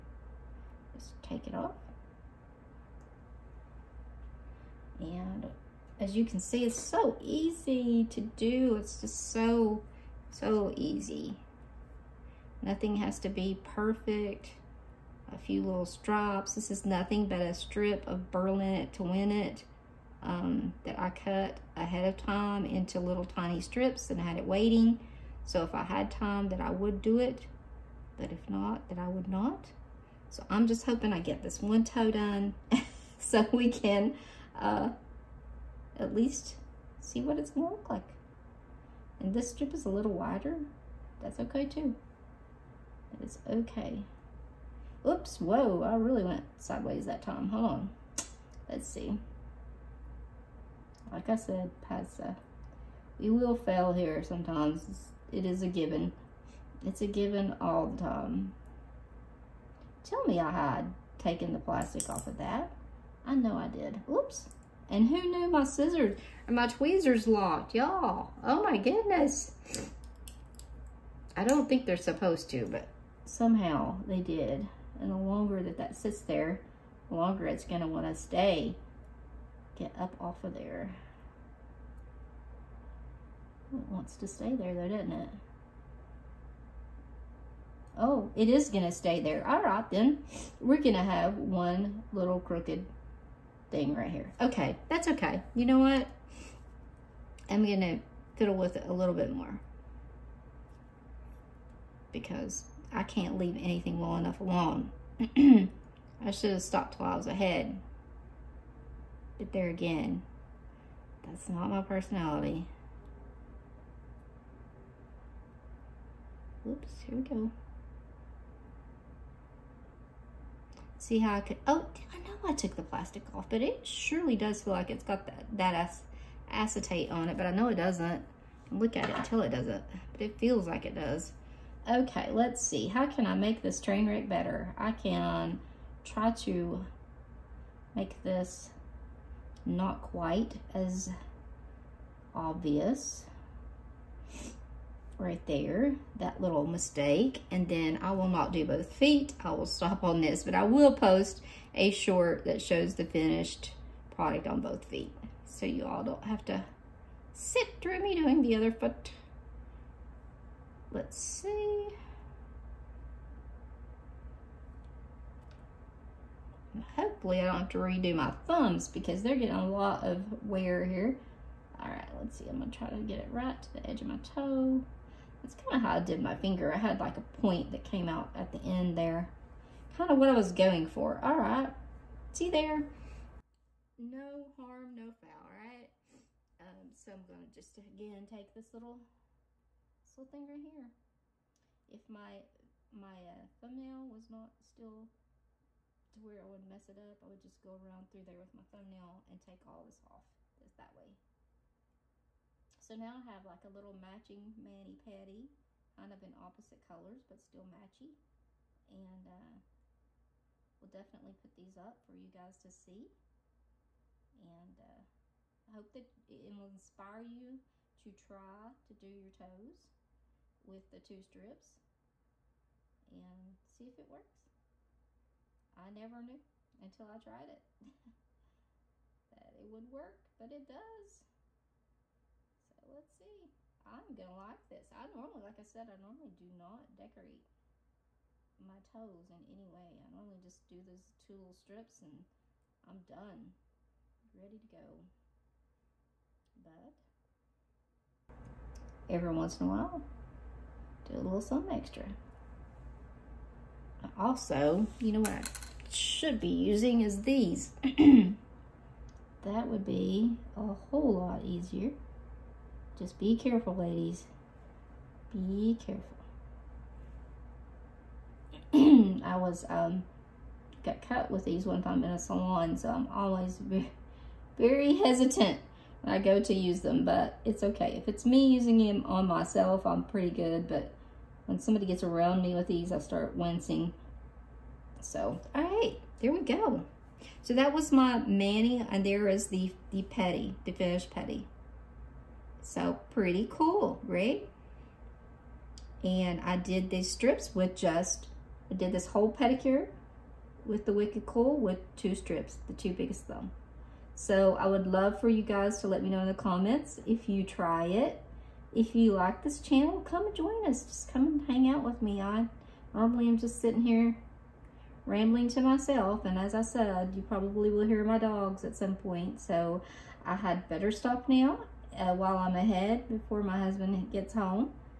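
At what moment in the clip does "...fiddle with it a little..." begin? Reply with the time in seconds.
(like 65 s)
98 s.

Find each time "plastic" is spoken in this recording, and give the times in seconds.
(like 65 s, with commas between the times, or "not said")
61 s, 122 s.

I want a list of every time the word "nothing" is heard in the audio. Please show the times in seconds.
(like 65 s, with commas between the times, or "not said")
12 s, 16 s.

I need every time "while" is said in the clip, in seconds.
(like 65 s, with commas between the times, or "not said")
106 s, 249 s, 322 s.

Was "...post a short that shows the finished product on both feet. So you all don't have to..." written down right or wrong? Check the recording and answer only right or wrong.
right.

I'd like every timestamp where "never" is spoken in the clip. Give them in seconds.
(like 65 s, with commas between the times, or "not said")
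225 s.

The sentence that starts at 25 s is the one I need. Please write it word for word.
So if I had time that I would do it, but if not, that I would not.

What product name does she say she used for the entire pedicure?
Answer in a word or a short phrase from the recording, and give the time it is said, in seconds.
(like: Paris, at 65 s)
Wicked Cool, at 300 s.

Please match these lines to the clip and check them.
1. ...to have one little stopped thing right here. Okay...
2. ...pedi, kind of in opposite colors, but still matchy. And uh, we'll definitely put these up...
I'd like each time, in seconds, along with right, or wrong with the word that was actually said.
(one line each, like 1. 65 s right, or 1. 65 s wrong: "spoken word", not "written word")
1. 90 s wrong: "crooked", not "stopped"
2. 205 s right.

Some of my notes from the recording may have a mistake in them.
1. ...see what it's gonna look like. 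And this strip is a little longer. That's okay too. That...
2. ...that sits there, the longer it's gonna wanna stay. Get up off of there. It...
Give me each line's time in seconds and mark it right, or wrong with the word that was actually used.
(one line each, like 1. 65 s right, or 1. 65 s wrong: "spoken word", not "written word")
1. 36 s wrong: "wider", not "longer"
2. 75 s right.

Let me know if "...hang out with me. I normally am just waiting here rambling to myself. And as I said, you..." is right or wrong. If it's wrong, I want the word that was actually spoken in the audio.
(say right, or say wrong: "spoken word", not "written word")
wrong: "sitting", not "waiting".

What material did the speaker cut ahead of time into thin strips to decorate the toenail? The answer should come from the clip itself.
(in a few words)
burlap.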